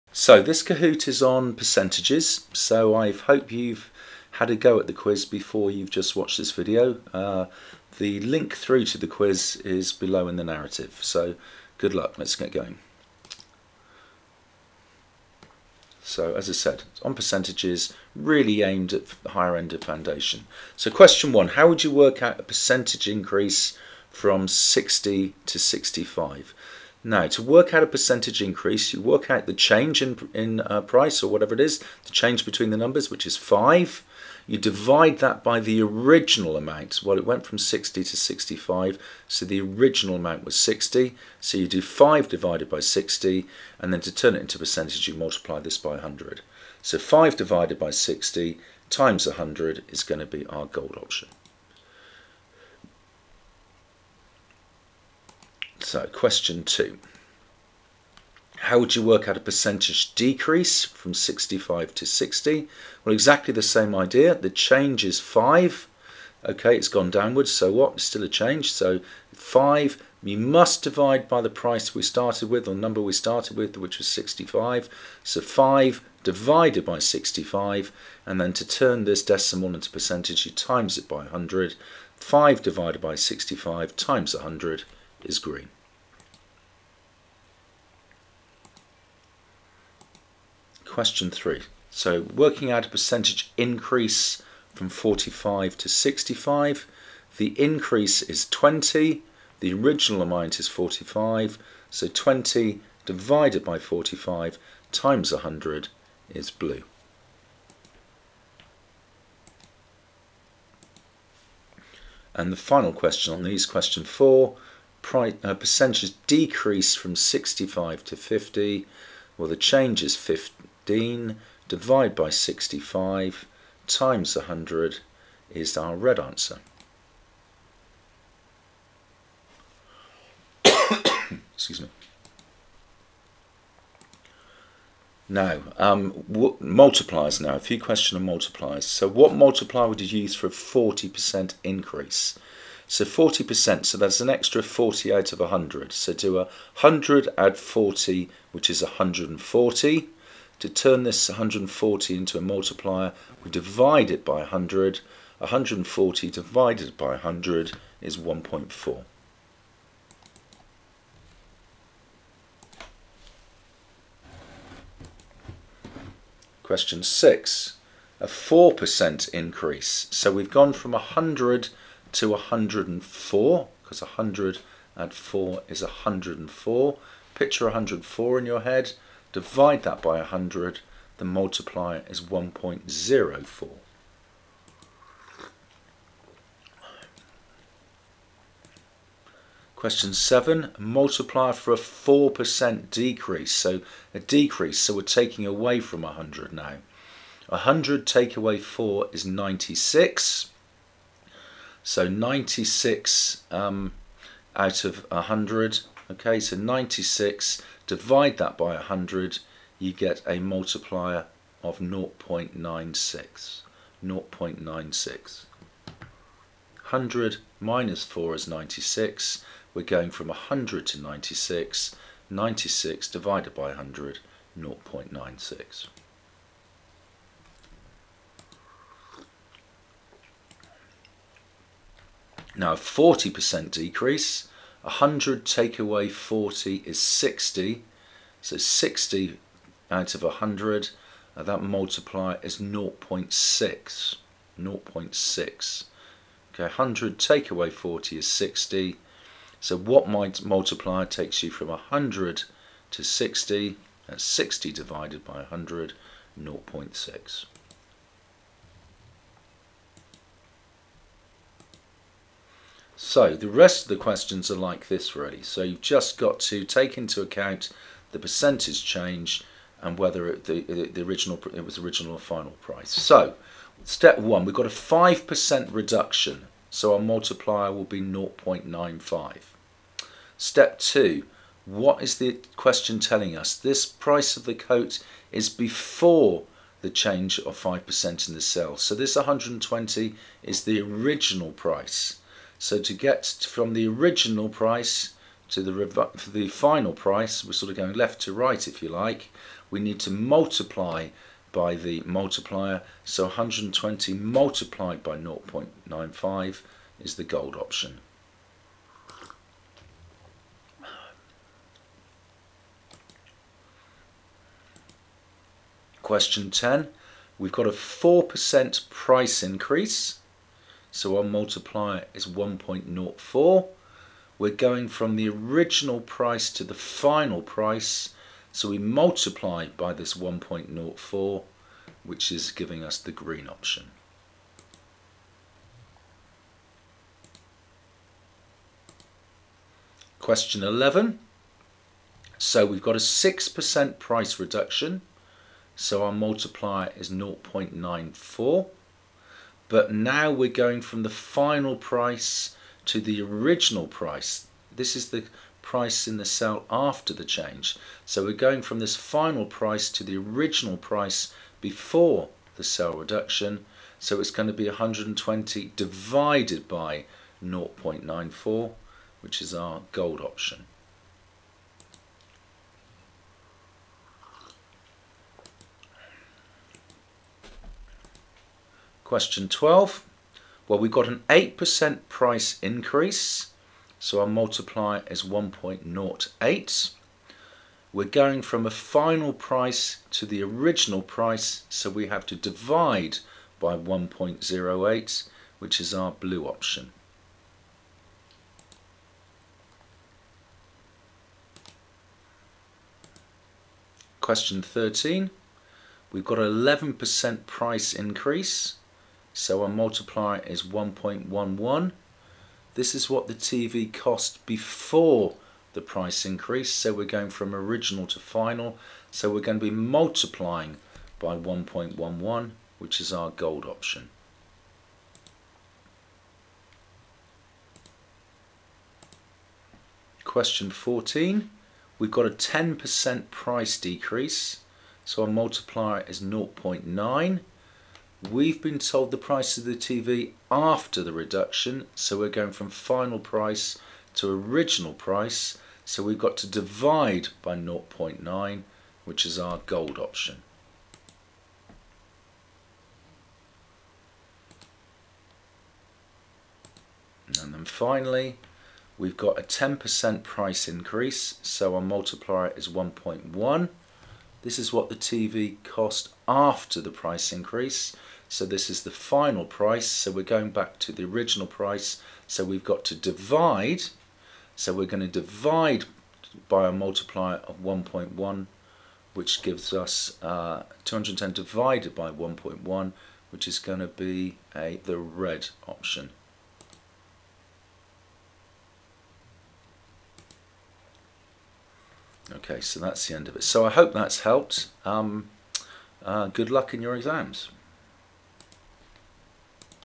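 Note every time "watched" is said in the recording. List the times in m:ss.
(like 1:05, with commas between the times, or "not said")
0:06.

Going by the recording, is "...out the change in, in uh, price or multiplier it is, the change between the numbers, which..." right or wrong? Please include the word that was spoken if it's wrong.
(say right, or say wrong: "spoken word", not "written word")
wrong: "whatever", not "multiplier".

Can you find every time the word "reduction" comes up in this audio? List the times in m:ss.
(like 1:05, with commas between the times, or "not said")
4:35, 5:44, 6:02, 7:21.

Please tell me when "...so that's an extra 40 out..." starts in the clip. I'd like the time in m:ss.
2:23.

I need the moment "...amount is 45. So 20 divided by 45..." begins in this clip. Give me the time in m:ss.
1:40.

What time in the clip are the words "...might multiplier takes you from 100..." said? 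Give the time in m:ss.
4:10.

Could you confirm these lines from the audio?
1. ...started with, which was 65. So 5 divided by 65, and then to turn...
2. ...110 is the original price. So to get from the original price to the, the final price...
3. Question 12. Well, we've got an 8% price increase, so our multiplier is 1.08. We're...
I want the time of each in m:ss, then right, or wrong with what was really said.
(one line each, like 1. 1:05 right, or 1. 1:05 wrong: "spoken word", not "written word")
1. 1:13 right
2. 4:49 wrong: "120", not "110"
3. 6:19 right.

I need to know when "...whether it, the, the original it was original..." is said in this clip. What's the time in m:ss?
4:29.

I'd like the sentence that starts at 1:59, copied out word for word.
Well, the change is 50 15 divide by 65 times 100 is our red answer.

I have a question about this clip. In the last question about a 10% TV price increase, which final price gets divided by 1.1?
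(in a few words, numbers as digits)
210.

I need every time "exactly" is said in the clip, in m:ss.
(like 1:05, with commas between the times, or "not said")
1:03.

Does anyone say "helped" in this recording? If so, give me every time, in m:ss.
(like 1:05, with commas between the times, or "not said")
8:14.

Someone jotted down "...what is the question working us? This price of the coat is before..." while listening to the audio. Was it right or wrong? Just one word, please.
wrong.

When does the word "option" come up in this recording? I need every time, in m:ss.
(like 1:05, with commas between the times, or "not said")
0:51, 5:07, 5:33, 6:10, 6:36, 7:03, 7:29, 8:05.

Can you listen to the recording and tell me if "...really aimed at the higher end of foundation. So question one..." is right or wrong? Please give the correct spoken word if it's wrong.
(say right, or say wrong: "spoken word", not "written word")
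right.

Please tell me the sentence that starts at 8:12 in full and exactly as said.
Okay, so that's the end of it.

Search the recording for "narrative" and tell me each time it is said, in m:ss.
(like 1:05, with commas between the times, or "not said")
0:10.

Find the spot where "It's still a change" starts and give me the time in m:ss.
1:07.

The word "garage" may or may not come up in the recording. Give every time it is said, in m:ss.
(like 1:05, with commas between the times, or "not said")
not said.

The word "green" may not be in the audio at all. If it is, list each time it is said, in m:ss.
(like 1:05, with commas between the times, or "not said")
1:25, 5:33.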